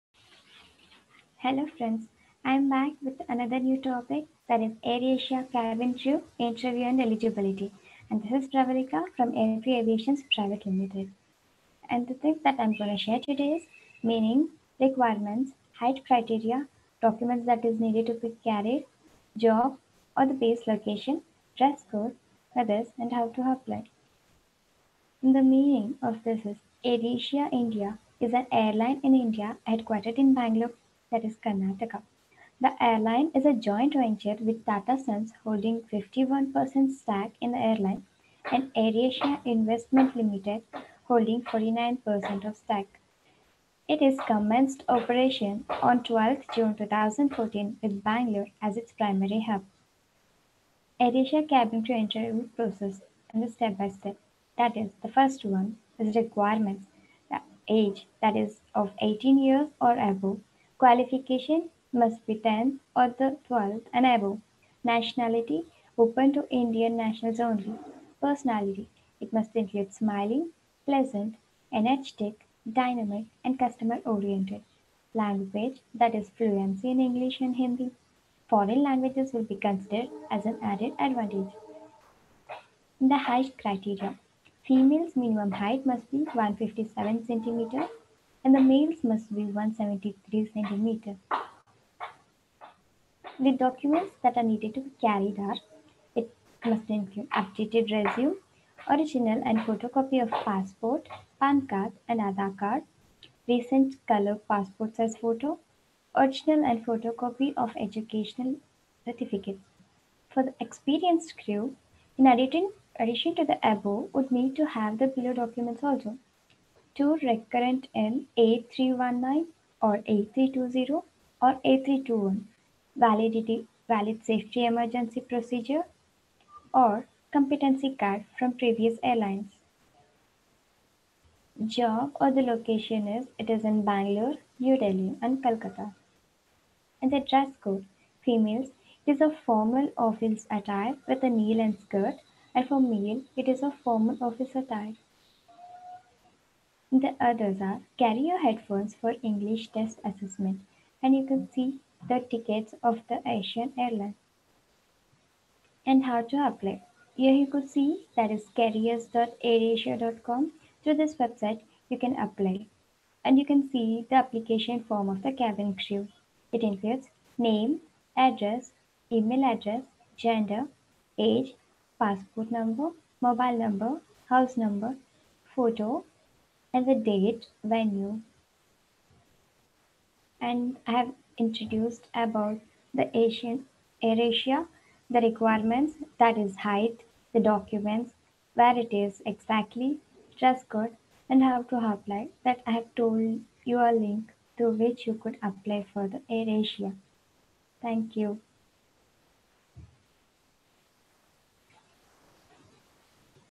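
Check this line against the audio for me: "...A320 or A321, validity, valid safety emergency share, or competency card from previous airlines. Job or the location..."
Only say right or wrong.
wrong.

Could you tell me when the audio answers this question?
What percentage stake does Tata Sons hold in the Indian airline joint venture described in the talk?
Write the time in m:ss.
0:35.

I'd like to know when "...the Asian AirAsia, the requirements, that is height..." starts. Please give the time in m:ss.
3:02.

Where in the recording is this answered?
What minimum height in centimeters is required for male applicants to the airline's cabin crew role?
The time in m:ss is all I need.
1:29.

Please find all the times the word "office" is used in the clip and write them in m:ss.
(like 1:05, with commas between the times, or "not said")
2:19, 2:24.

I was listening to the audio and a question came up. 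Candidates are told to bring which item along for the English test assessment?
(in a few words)
Headphones.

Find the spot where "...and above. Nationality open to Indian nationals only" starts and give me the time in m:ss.
1:03.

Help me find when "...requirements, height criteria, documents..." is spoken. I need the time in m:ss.
0:14.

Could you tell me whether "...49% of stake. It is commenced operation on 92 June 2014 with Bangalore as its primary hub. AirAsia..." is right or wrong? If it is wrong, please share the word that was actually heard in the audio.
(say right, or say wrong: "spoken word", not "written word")
wrong: "12", not "92".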